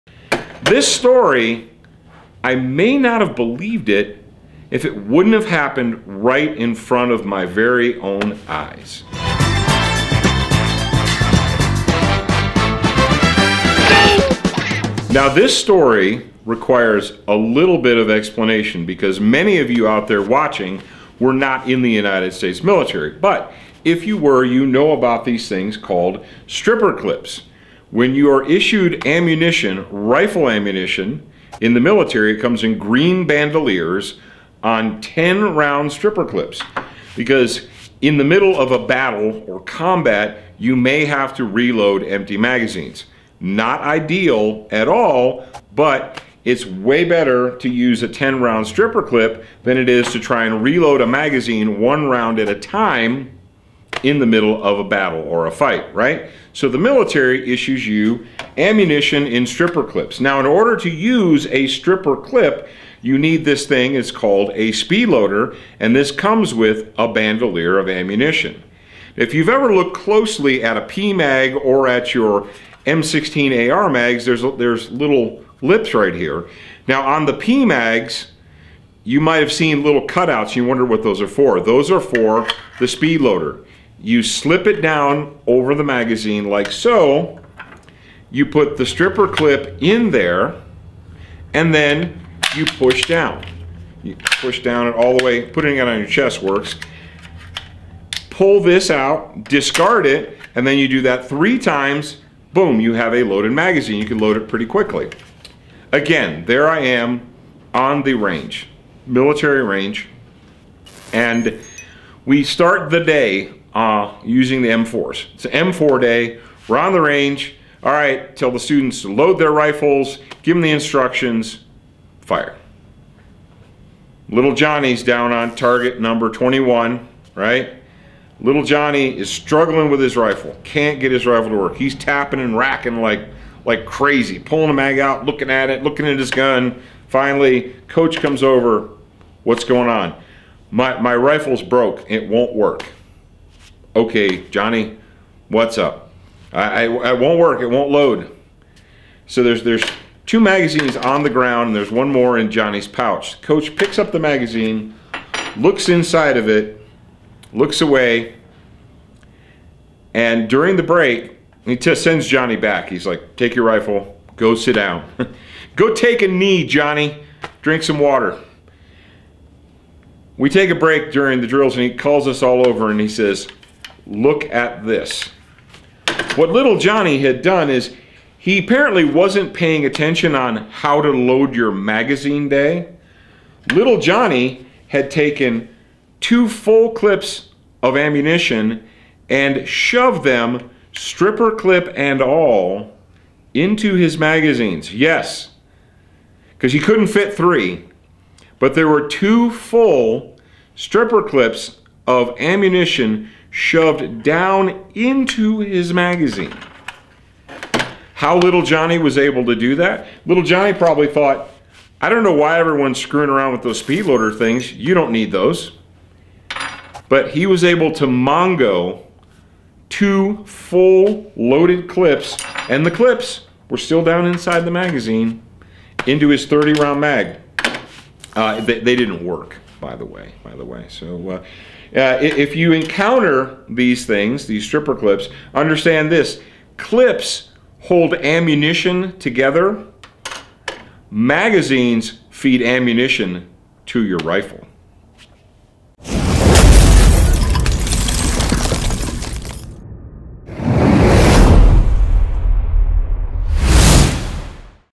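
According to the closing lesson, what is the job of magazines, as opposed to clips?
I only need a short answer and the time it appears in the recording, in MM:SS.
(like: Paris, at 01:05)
Feed ammunition to your rifle, at 04:02.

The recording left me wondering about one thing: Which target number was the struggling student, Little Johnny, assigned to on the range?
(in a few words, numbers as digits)
21.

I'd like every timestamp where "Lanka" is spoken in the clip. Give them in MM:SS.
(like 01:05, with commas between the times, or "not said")
not said.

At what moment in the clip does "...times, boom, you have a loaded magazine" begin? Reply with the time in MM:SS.
01:41.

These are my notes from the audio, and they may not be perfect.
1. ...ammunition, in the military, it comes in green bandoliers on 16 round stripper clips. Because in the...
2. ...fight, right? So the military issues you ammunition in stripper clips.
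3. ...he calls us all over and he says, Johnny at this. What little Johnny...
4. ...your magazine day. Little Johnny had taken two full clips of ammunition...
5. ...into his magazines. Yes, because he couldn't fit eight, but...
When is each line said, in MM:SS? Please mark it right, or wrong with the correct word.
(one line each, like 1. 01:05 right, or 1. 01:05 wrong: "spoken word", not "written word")
1. 00:30 wrong: "10", not "16"
2. 00:55 right
3. 02:51 wrong: "Look", not "Johnny"
4. 03:01 right
5. 03:13 wrong: "three", not "eight".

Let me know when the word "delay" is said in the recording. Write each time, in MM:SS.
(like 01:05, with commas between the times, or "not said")
not said.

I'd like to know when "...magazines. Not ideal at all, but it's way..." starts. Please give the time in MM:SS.
00:42.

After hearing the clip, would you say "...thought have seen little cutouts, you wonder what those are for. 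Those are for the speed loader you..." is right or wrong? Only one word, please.
wrong.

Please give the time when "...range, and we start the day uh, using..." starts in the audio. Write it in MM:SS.
01:49.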